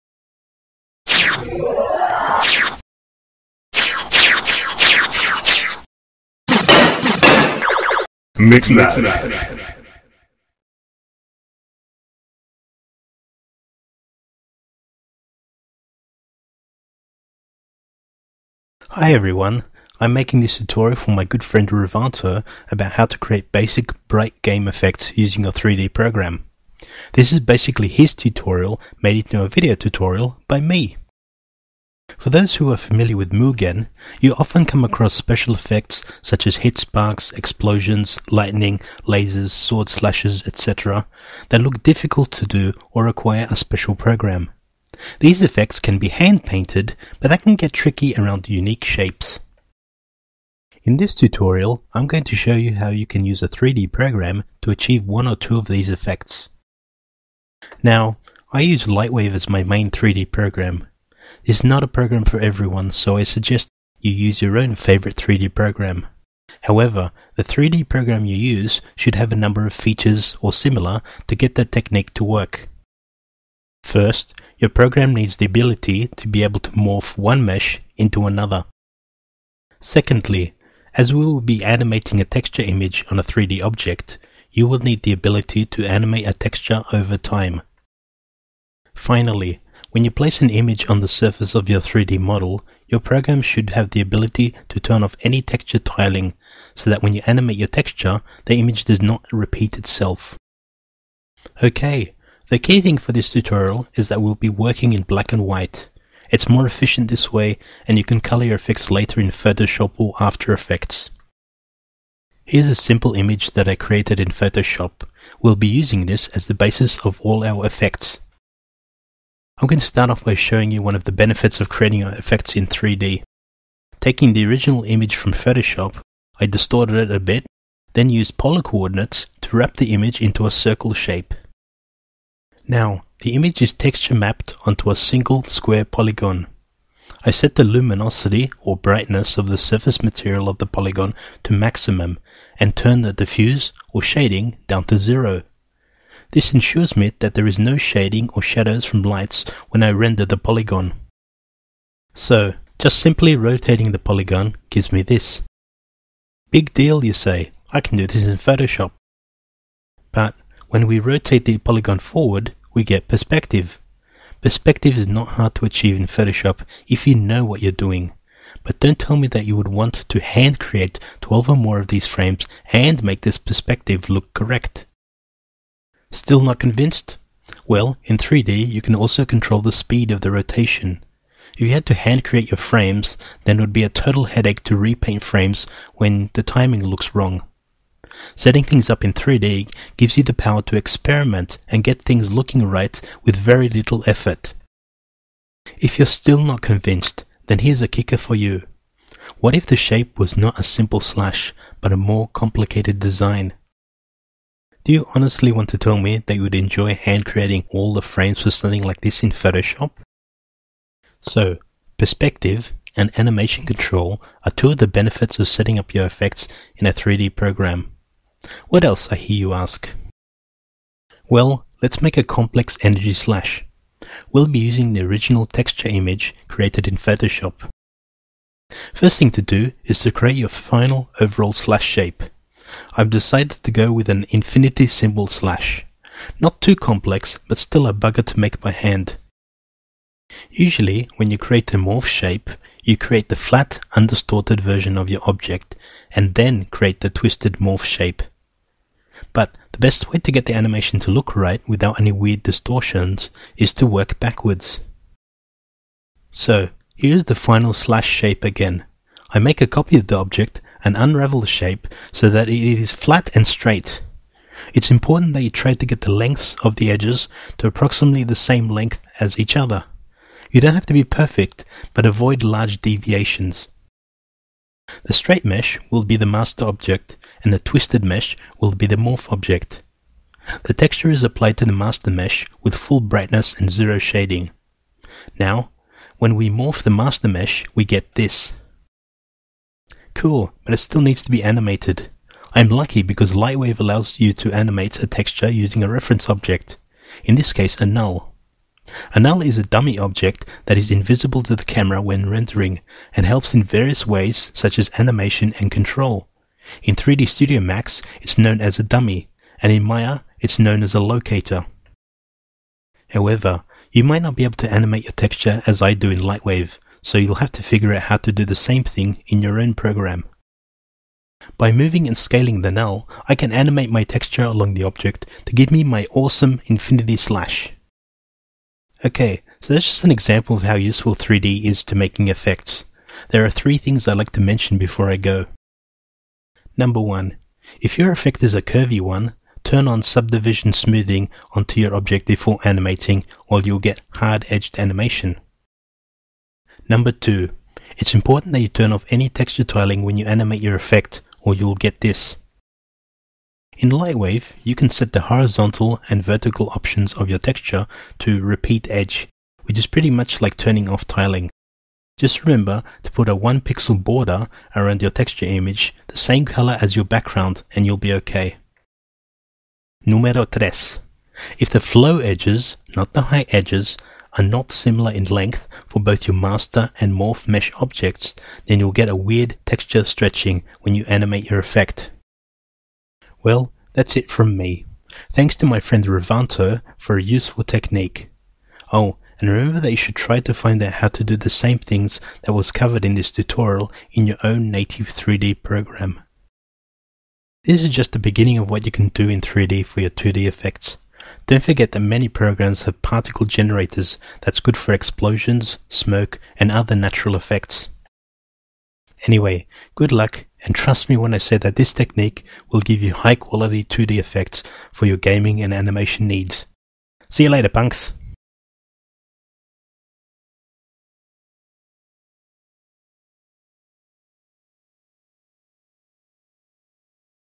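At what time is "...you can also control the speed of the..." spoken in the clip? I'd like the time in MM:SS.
02:58.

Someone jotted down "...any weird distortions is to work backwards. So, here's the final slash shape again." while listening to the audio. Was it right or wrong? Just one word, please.
right.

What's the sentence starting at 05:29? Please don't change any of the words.
Okay, so that's just an example of how useful 3D is to making effects.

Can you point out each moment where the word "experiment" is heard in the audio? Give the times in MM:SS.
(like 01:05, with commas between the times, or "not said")
03:10.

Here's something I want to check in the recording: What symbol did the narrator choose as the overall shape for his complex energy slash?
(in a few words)
infinity symbol.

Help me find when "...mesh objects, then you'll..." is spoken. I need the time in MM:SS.
06:17.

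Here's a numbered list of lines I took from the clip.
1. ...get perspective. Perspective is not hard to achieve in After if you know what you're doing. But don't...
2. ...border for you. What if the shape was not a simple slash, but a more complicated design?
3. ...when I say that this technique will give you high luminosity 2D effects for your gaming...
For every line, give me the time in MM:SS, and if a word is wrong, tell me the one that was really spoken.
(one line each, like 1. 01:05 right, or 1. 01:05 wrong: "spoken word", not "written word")
1. 02:42 wrong: "Photoshop", not "After"
2. 03:17 wrong: "kicker", not "border"
3. 06:51 wrong: "quality", not "luminosity".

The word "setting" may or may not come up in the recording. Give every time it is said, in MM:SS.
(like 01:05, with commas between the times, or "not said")
03:08, 03:35.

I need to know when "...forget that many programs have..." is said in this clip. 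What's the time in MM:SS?
06:41.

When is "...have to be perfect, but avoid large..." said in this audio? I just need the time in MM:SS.
04:30.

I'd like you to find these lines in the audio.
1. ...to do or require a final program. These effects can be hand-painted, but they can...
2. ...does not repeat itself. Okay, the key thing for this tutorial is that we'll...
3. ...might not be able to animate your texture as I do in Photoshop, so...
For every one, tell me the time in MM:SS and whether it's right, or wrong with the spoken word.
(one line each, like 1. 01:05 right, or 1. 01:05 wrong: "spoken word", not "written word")
1. 00:42 wrong: "special", not "final"
2. 01:38 right
3. 05:14 wrong: "Lightwave", not "Photoshop".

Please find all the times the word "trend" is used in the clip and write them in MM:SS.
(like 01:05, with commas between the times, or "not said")
not said.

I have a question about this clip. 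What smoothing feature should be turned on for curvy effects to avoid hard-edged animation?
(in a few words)
subdivision smoothing.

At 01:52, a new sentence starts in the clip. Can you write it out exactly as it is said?
Here's a simple image that I created in Photoshop.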